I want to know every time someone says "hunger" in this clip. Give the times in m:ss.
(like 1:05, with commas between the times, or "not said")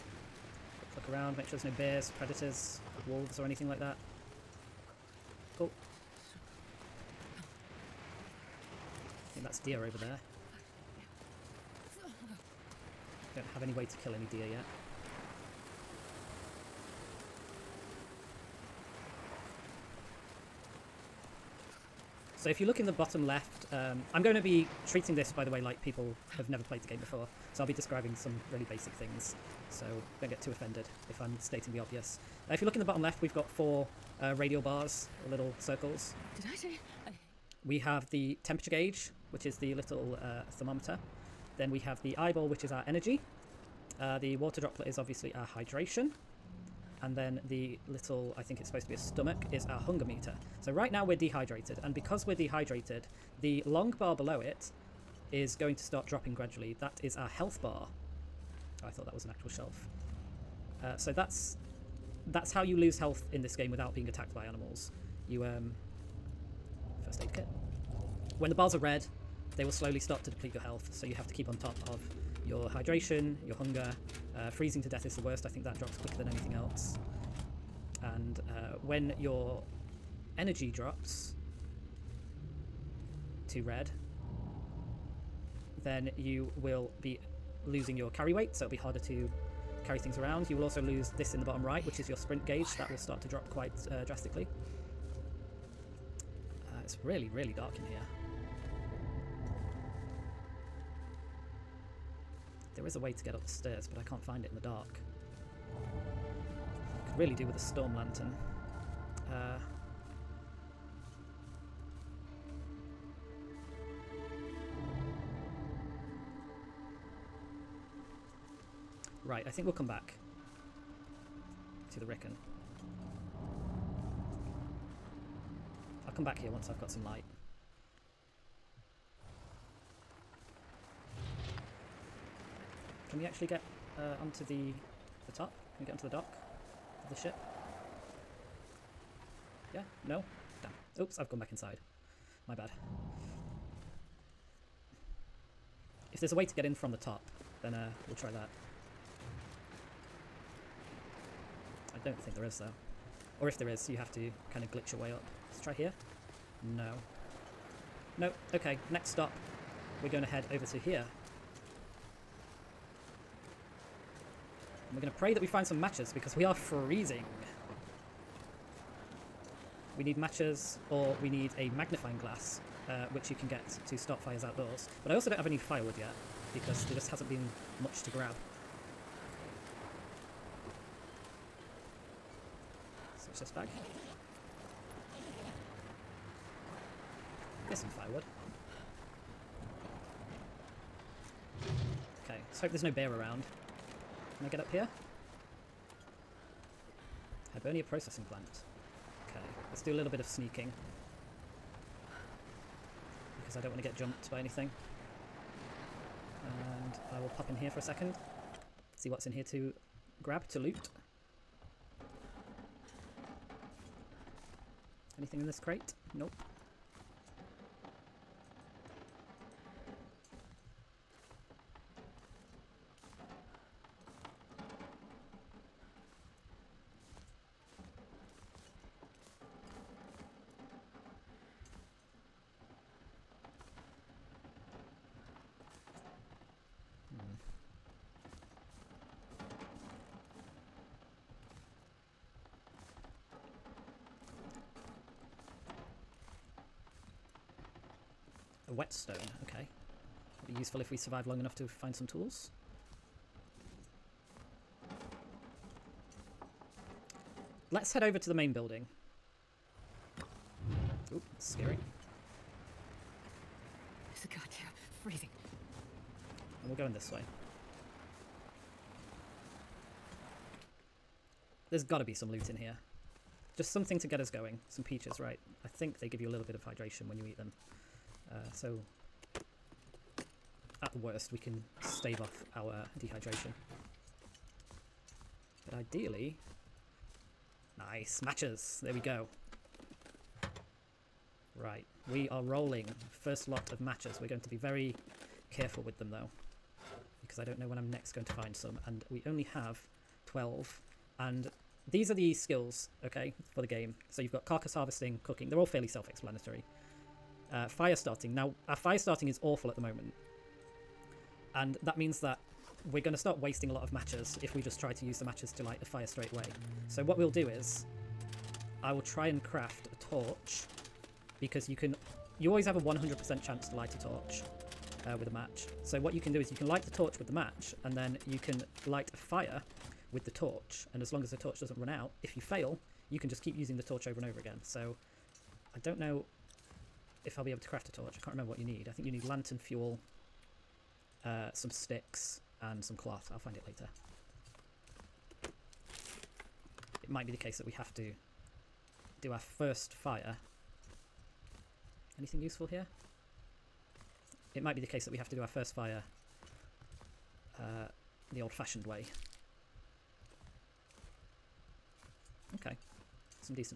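0:49, 1:13.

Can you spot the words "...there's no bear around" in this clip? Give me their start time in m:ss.
3:12.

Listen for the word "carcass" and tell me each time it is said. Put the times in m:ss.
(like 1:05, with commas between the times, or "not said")
5:04.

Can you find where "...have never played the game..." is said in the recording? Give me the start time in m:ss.
0:26.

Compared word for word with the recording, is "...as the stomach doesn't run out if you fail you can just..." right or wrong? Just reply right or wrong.
wrong.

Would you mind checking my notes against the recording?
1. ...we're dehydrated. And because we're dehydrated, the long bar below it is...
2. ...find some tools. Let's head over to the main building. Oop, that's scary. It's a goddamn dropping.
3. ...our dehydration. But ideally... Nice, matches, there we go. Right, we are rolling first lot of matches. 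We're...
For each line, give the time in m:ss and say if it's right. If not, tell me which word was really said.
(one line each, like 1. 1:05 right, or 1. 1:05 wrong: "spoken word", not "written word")
1. 0:51 right
2. 4:11 wrong: "freezing", not "dropping"
3. 4:42 right.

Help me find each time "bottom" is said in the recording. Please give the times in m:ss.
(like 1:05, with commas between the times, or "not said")
0:22, 0:32, 1:31.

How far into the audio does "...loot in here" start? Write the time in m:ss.
4:32.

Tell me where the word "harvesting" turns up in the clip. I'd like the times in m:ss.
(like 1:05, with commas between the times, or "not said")
5:04.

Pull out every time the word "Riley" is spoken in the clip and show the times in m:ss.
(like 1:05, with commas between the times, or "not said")
not said.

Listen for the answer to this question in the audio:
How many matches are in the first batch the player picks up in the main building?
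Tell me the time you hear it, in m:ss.
5:00.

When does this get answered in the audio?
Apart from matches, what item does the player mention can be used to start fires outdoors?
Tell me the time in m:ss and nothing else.
2:51.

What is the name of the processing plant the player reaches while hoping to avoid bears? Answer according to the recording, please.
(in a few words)
Hibernia.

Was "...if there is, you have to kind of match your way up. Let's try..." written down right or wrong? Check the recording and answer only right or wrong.
wrong.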